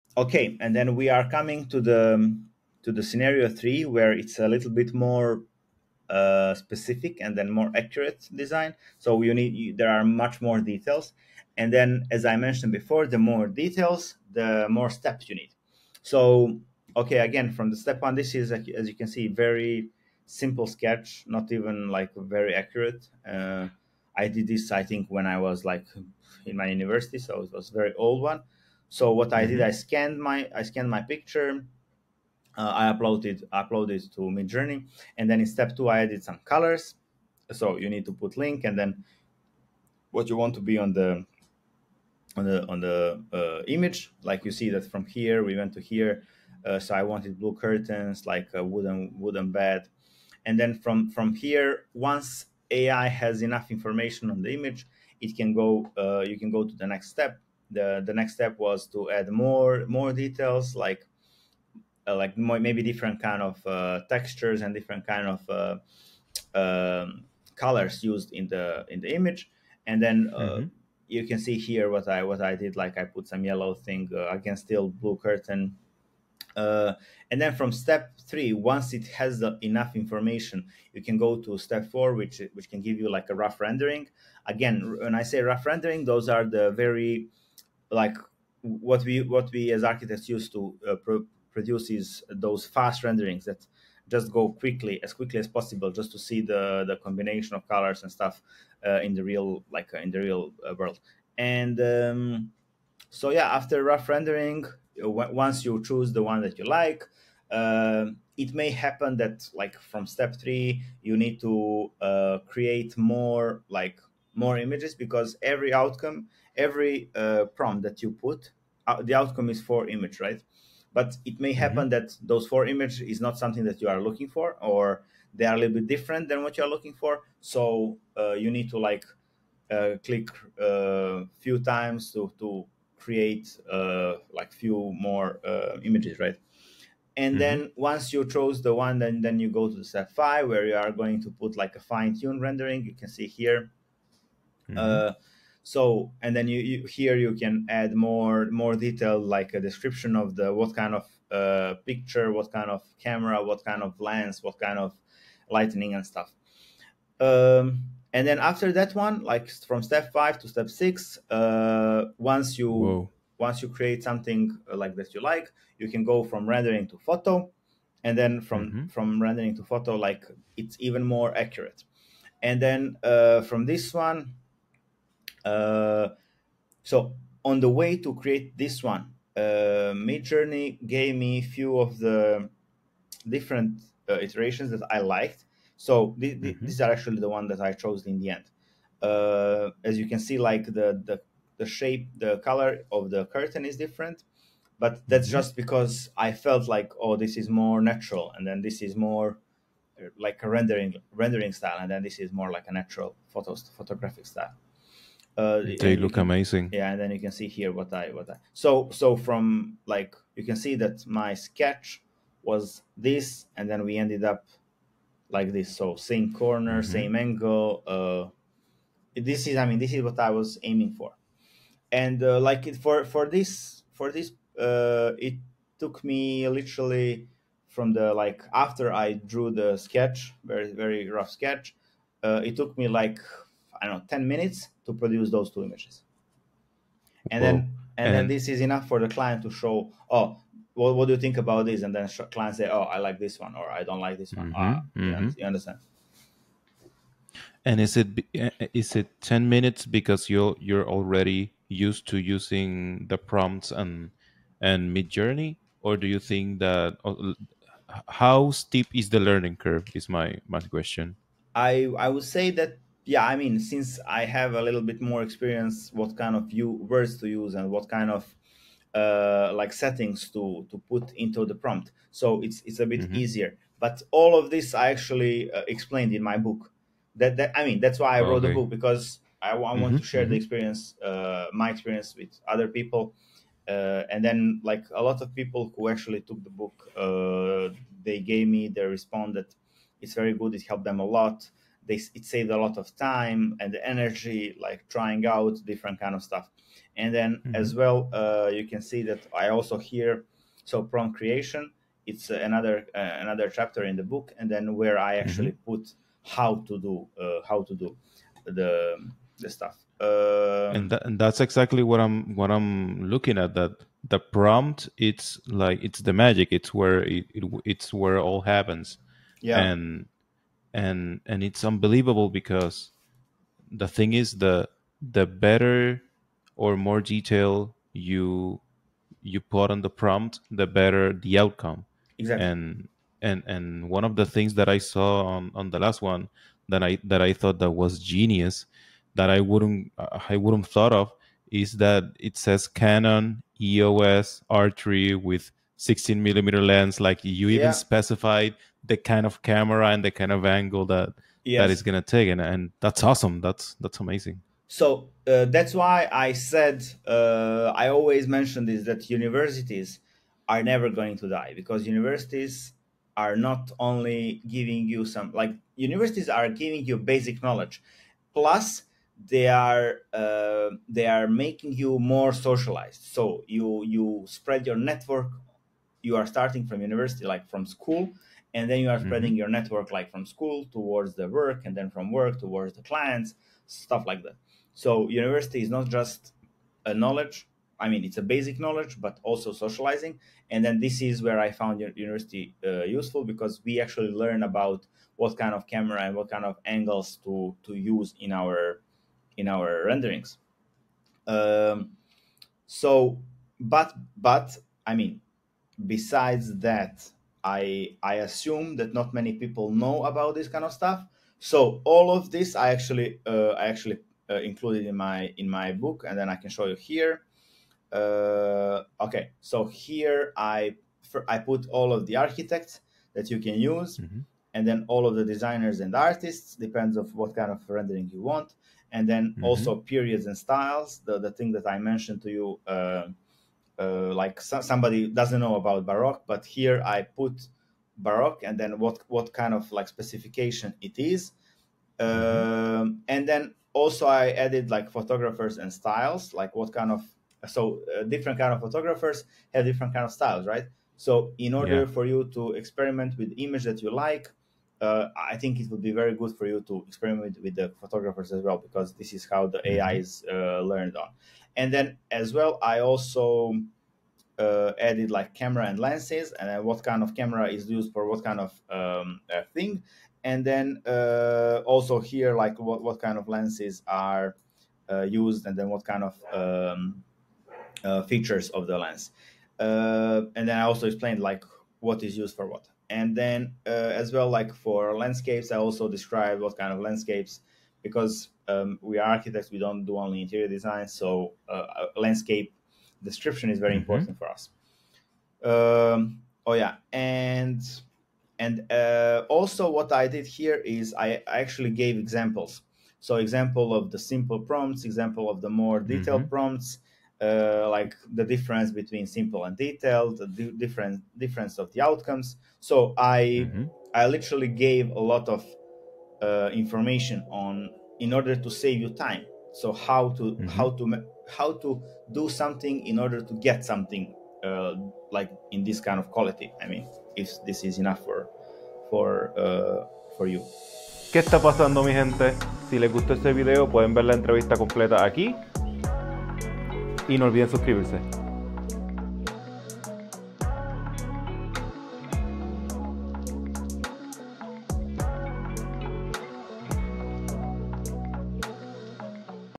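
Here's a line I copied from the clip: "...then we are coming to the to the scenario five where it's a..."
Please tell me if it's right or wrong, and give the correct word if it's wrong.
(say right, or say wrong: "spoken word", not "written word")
wrong: "three", not "five".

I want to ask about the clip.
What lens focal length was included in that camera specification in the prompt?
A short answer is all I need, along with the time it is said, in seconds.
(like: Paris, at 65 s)
16 millimeter, at 345 s.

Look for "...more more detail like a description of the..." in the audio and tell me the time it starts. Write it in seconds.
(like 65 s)
147 s.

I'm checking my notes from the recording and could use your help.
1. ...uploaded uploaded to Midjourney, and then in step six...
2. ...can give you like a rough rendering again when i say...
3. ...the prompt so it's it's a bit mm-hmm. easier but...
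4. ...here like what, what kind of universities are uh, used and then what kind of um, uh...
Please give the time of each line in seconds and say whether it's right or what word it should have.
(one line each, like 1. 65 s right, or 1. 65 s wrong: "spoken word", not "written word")
1. 32 s wrong: "two", not "six"
2. 82 s right
3. 271 s right
4. 471 s wrong: "lenses", not "universities".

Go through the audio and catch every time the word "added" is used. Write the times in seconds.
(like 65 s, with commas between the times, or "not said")
36 s, 444 s, 464 s.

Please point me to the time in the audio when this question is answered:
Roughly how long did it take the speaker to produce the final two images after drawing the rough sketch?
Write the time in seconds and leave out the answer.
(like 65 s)
234 s.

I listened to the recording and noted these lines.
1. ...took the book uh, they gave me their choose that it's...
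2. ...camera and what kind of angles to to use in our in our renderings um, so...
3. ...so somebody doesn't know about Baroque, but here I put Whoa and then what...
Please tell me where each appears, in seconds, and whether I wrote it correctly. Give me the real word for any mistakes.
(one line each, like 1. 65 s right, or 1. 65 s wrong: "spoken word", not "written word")
1. 286 s wrong: "response", not "choose"
2. 395 s right
3. 434 s wrong: "Baroque", not "Whoa".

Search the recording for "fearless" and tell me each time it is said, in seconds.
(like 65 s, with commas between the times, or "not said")
not said.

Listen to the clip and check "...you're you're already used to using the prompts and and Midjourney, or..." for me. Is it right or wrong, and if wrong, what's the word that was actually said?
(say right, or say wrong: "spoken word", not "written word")
right.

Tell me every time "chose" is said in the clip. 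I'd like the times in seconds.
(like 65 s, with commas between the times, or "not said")
138 s, 187 s.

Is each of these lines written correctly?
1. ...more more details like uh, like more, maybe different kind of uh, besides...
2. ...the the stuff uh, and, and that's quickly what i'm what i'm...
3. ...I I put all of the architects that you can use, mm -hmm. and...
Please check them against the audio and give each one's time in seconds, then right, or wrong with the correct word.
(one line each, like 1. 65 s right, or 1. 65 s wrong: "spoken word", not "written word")
1. 59 s wrong: "textures", not "besides"
2. 308 s wrong: "exactly", not "quickly"
3. 420 s right.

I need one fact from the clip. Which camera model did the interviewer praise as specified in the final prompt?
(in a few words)
Canon EOS R3.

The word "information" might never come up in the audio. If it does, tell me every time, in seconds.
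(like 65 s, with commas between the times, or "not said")
53 s, 79 s, 516 s.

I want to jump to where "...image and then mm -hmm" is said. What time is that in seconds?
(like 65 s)
69 s.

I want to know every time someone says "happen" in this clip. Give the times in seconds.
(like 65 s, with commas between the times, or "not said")
108 s, 121 s, 318 s.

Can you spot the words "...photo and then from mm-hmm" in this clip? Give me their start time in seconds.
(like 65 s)
166 s.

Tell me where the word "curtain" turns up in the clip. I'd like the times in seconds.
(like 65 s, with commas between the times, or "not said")
47 s, 75 s, 193 s.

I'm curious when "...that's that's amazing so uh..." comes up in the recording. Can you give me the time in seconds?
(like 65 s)
353 s.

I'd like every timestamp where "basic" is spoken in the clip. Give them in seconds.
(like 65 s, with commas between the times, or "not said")
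366 s, 388 s.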